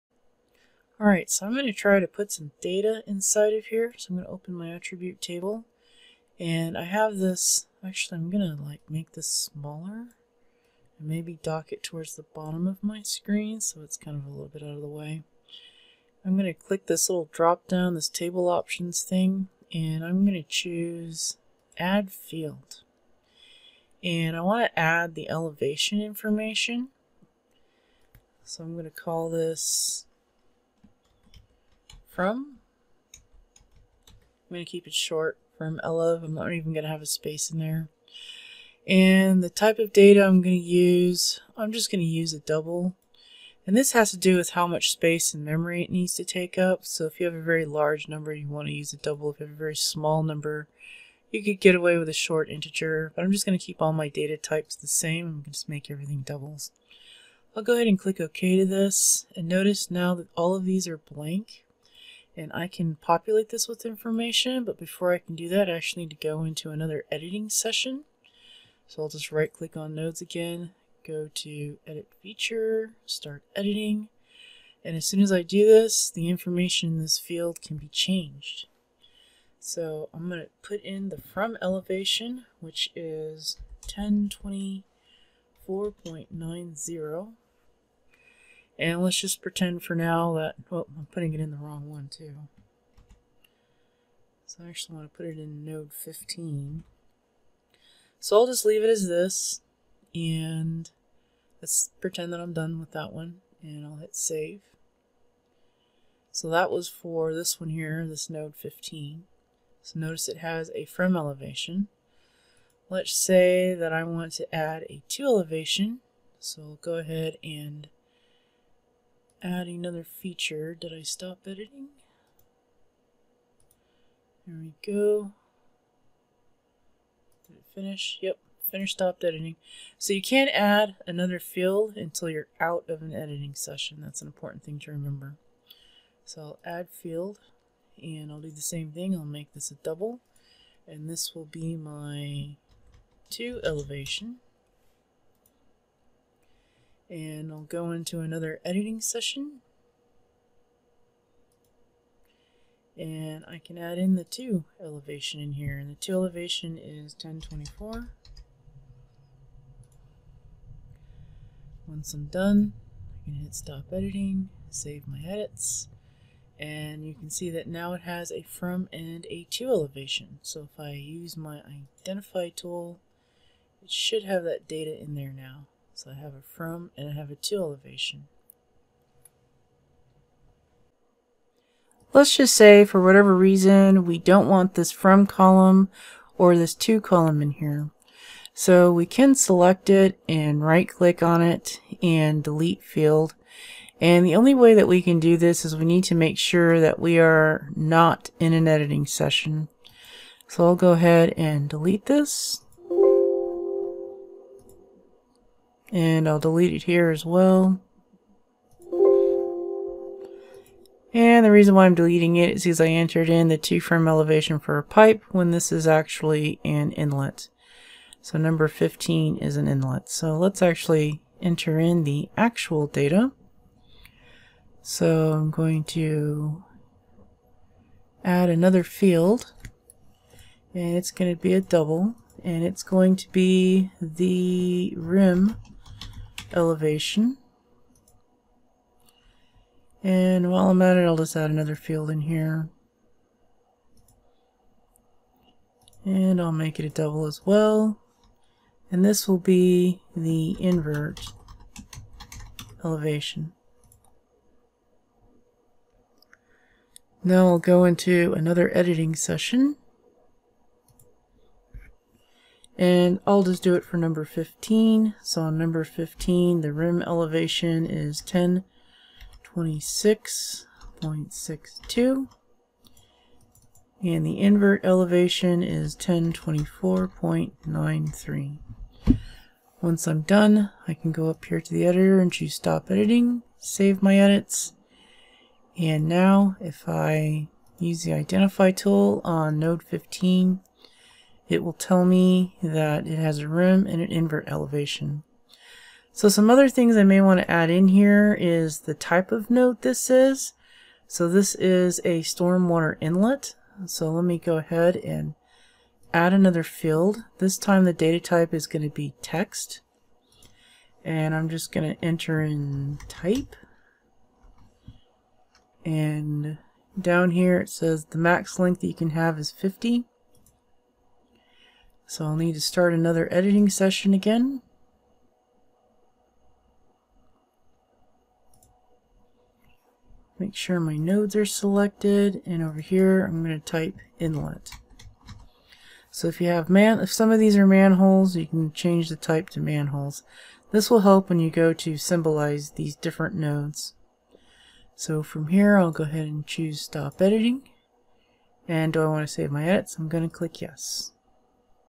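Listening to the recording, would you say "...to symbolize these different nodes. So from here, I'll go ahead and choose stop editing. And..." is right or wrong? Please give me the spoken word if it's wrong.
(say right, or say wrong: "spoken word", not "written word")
right.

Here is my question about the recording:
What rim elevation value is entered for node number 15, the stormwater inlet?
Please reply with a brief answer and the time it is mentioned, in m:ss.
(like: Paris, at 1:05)
1026.62, at 4:28.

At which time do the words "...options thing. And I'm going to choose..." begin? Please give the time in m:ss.
0:18.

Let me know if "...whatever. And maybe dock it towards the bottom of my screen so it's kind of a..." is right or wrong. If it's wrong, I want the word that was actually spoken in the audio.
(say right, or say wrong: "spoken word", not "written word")
wrong: "smaller", not "whatever".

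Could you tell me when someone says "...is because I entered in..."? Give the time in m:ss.
3:32.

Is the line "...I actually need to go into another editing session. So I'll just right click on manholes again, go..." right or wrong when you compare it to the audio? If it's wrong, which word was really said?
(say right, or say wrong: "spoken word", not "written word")
wrong: "nodes", not "manholes".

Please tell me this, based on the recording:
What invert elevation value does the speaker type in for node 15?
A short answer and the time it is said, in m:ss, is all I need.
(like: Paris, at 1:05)
1024.93, at 4:35.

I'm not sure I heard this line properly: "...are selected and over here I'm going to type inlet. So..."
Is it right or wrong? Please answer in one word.
right.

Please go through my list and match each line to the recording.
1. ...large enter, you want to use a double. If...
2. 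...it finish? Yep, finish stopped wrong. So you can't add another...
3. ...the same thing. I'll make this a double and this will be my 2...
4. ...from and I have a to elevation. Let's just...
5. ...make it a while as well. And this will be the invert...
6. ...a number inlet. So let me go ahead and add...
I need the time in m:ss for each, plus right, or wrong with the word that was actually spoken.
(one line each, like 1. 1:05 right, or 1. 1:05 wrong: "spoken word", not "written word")
1. 0:47 wrong: "number", not "enter"
2. 2:07 wrong: "editing", not "wrong"
3. 2:18 right
4. 2:56 right
5. 4:06 wrong: "double", not "while"
6. 5:02 wrong: "stormwater", not "number".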